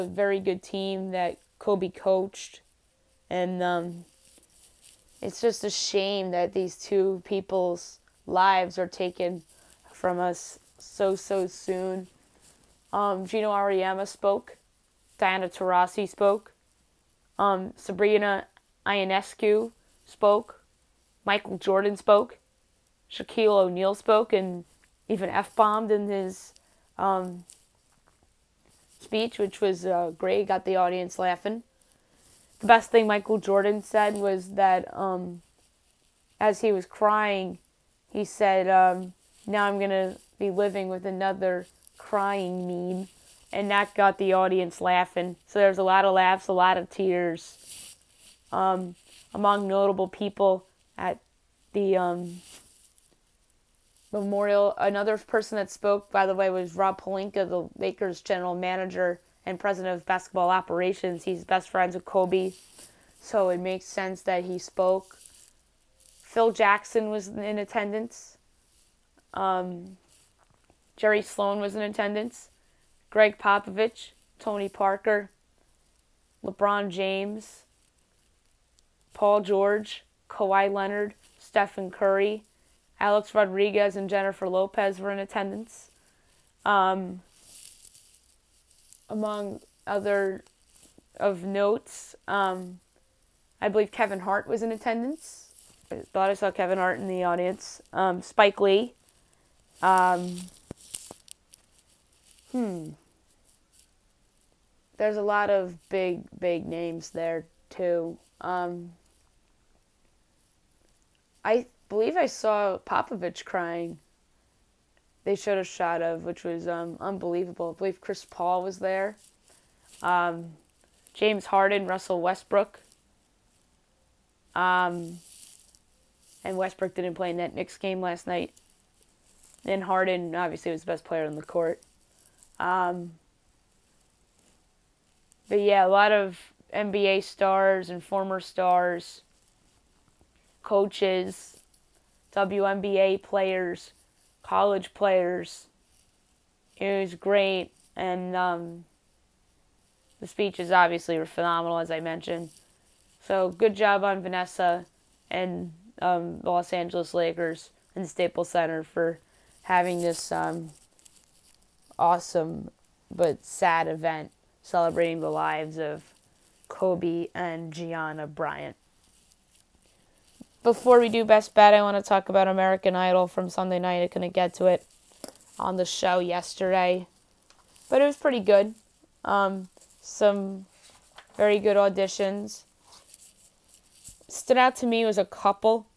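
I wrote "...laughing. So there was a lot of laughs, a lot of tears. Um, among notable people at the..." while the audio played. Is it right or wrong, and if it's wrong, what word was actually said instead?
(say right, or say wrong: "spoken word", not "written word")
right.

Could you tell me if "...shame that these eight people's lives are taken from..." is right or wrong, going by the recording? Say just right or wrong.
wrong.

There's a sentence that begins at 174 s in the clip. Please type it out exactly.
I couldn't get to it on the show yesterday, but it was pretty good.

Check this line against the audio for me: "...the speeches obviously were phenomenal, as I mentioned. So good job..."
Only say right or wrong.
right.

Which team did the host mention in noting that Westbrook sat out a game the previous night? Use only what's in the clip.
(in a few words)
Knicks.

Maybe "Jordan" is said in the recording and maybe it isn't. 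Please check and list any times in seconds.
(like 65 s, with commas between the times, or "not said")
21 s, 33 s.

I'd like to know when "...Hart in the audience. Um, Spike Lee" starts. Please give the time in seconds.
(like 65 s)
96 s.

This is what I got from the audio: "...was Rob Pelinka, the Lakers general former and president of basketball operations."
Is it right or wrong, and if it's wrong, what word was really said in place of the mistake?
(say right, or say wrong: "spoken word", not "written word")
wrong: "manager", not "former".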